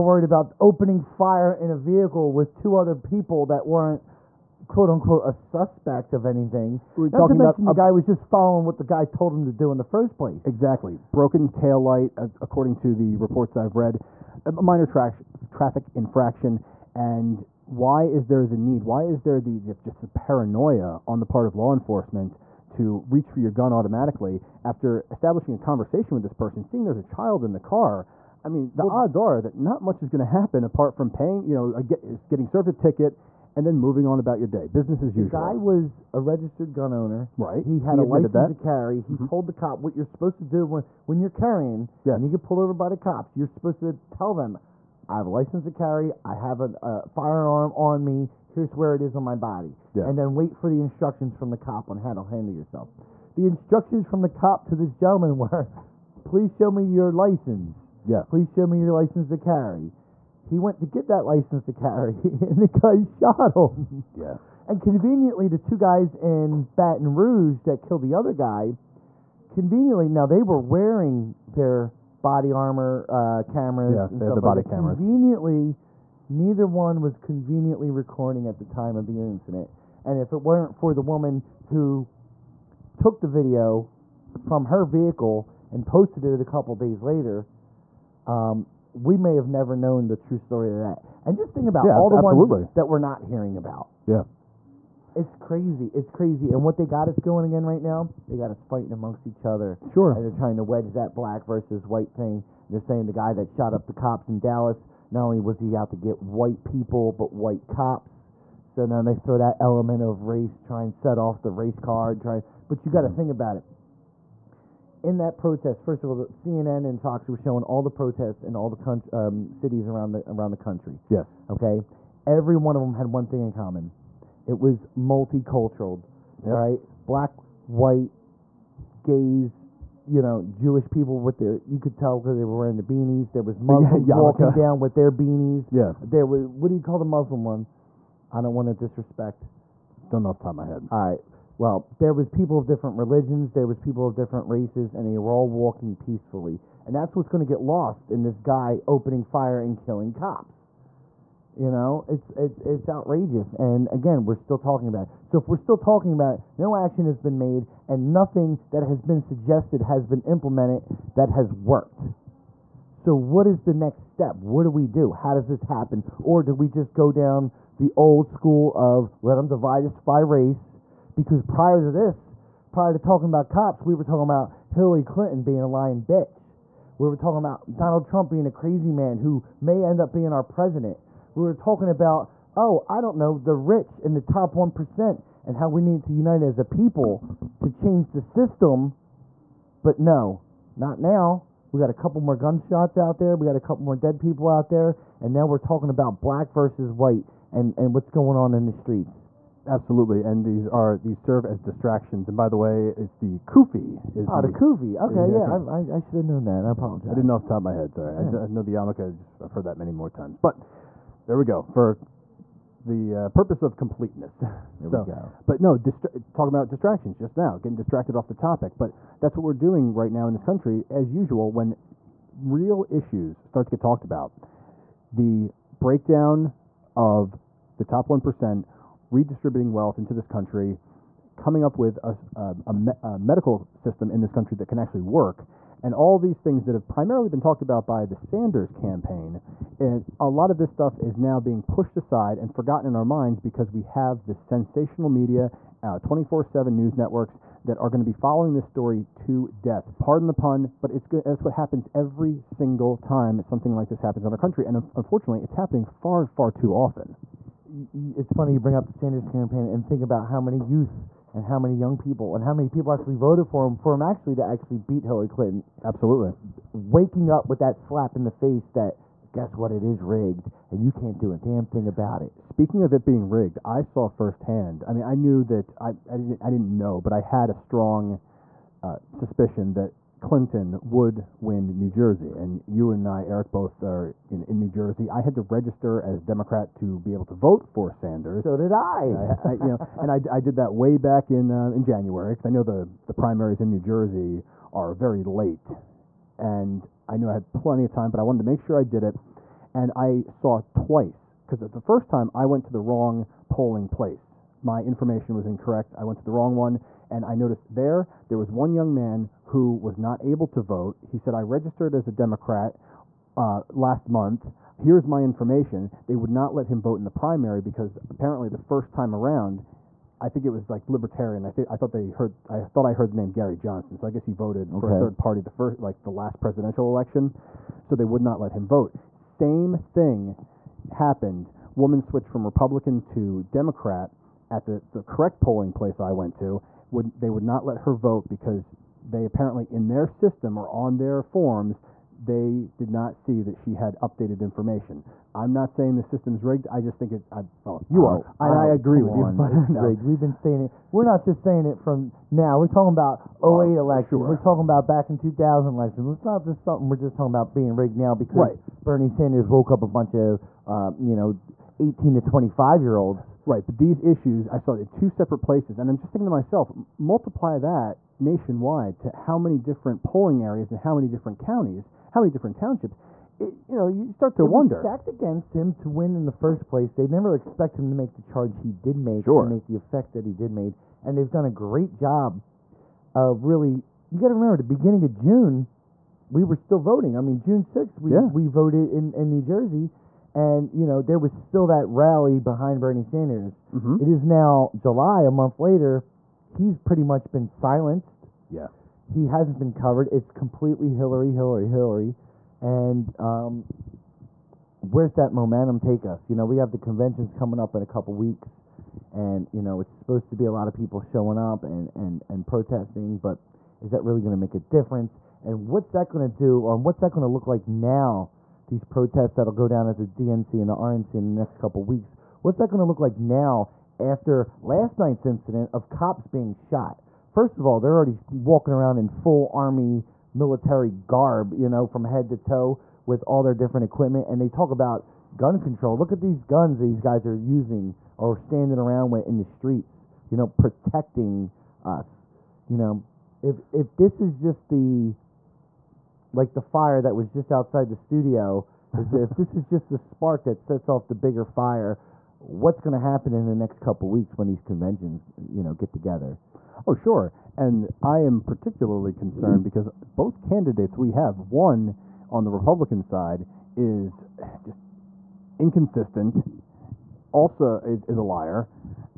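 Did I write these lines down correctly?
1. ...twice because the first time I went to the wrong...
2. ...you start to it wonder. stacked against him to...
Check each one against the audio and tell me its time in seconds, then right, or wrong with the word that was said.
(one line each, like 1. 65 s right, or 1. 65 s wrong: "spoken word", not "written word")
1. 300 s right
2. 373 s right.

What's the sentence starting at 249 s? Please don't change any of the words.
Pardon the pun, but it's good.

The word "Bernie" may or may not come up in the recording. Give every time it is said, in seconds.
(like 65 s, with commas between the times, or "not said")
358 s, 392 s.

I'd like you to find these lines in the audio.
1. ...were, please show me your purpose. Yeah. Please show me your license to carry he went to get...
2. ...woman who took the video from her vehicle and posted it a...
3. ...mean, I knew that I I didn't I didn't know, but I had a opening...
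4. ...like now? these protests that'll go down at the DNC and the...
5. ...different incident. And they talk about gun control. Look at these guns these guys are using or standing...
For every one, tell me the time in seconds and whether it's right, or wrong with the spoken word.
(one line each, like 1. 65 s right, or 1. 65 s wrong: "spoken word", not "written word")
1. 55 s wrong: "license", not "purpose"
2. 81 s right
3. 274 s wrong: "strong", not "opening"
4. 417 s right
5. 433 s wrong: "equipment", not "incident".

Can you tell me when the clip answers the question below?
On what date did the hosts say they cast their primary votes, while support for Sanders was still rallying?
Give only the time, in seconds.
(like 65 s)
387 s.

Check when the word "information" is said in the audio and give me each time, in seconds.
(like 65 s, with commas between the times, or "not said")
304 s, 315 s, 344 s.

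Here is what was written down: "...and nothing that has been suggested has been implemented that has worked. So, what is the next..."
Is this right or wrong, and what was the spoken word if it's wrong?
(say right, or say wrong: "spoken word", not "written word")
right.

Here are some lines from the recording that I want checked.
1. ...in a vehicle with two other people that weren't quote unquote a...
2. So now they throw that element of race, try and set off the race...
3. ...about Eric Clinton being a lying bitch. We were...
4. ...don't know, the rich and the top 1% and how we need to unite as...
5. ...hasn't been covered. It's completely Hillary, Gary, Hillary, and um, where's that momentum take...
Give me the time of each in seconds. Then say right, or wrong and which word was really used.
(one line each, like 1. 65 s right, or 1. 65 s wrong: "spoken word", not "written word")
1. 1 s right
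2. 108 s right
3. 174 s wrong: "Hillary", not "Eric"
4. 183 s right
5. 399 s wrong: "Hillary", not "Gary".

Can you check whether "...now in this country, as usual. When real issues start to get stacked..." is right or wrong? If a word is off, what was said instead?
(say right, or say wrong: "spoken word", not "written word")
wrong: "talked", not "stacked".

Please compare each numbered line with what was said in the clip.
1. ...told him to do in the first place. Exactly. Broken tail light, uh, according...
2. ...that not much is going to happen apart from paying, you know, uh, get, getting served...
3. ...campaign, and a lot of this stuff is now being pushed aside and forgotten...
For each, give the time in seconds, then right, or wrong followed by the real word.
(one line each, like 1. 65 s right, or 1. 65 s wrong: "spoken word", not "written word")
1. 9 s right
2. 29 s right
3. 238 s right.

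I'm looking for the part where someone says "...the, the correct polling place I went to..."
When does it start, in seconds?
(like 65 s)
334 s.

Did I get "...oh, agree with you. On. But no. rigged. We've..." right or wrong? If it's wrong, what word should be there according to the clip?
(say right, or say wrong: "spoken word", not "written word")
right.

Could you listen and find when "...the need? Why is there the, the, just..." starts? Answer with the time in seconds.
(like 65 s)
18 s.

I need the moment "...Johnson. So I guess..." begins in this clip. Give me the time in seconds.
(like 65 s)
323 s.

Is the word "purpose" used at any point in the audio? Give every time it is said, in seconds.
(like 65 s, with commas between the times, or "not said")
213 s.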